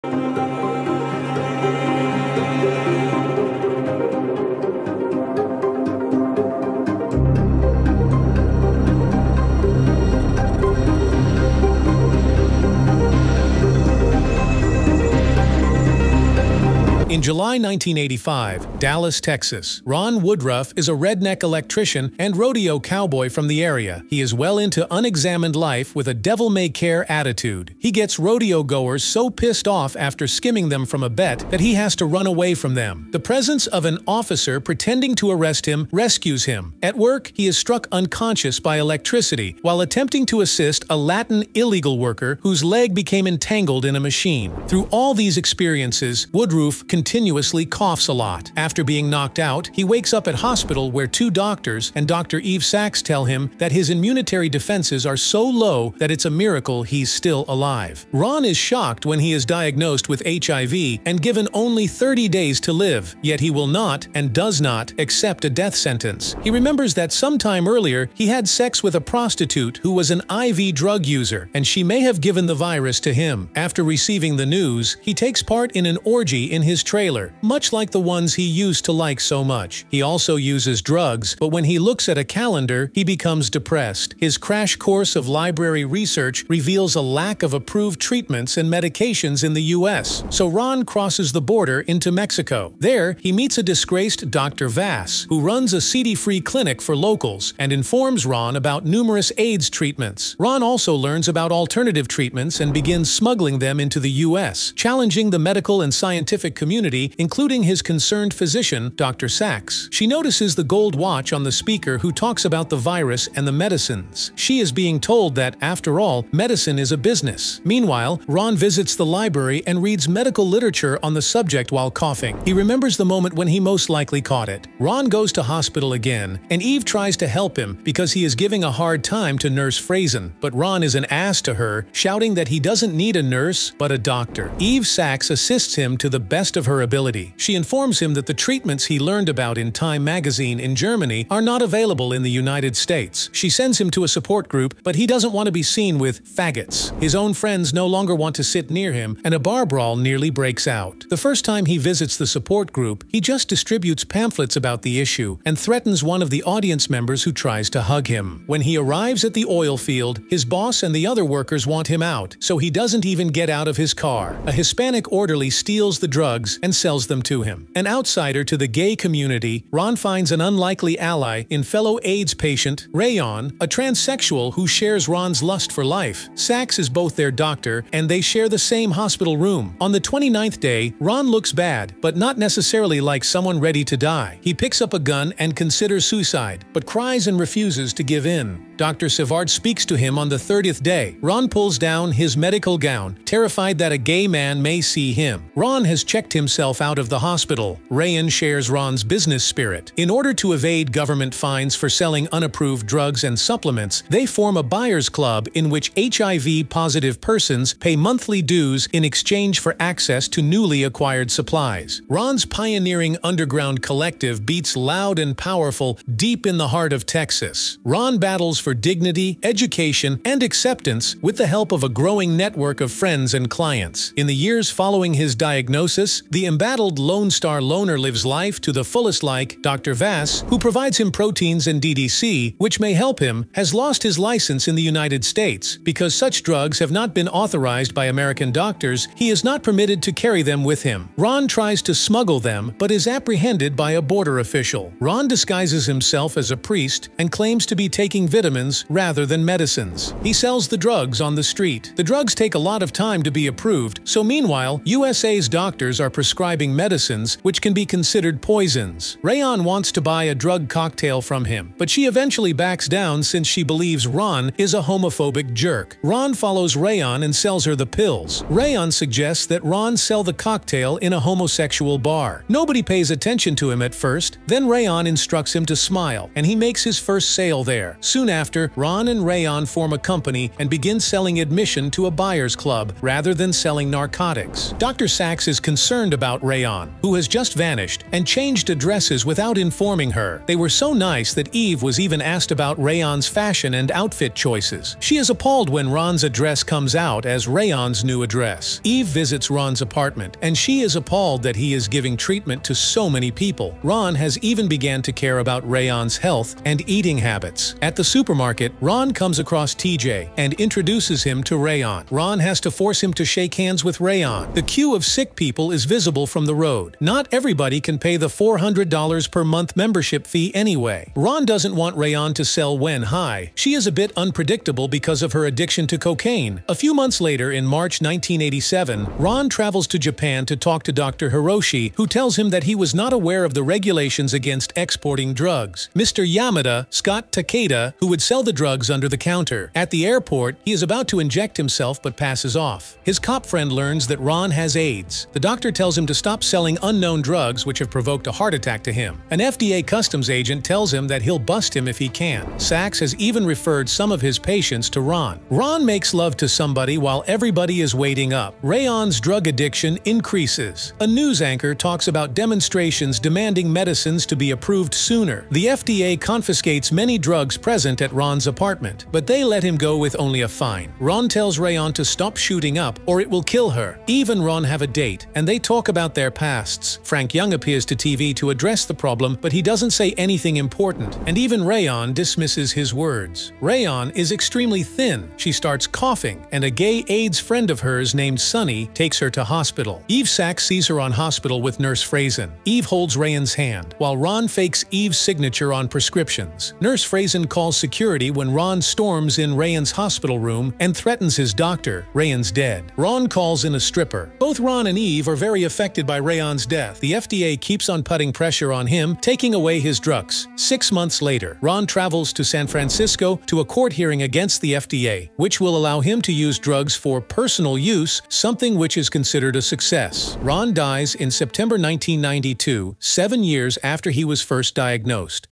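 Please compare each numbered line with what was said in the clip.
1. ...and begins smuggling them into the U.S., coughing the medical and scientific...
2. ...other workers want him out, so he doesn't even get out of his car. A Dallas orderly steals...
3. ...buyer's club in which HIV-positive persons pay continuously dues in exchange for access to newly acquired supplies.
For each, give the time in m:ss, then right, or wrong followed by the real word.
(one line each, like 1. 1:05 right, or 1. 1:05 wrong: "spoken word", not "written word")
1. 1:42 wrong: "challenging", not "coughing"
2. 2:41 wrong: "Hispanic", not "Dallas"
3. 3:24 wrong: "monthly", not "continuously".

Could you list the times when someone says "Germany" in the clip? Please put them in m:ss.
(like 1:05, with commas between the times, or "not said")
2:20.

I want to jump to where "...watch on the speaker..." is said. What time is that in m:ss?
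1:50.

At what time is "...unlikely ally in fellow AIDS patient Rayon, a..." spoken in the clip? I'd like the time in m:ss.
2:50.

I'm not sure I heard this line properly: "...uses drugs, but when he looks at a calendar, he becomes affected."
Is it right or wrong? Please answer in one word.
wrong.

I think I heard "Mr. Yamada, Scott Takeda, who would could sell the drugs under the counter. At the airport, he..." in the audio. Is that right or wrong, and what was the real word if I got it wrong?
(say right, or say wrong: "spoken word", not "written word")
right.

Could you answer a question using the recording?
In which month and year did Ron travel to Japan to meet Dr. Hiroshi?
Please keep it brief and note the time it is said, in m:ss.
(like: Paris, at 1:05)
March 1987, at 5:27.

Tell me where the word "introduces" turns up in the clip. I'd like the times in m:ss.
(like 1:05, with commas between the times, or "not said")
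5:10.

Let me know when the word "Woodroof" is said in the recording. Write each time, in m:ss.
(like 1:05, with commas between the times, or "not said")
0:20, 0:46.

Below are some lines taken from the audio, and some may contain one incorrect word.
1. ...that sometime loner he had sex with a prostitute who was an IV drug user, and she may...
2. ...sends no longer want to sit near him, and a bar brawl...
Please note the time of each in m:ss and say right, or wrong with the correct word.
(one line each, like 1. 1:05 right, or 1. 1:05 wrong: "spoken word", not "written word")
1. 1:06 wrong: "earlier", not "loner"
2. 2:27 wrong: "friends", not "sends".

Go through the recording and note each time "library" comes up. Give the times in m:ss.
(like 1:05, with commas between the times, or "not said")
1:25, 1:59.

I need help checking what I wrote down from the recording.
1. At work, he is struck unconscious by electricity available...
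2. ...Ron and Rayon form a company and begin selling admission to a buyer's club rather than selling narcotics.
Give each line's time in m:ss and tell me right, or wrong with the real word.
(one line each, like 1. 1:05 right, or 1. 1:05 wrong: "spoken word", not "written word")
1. 0:36 wrong: "while", not "available"
2. 4:38 right.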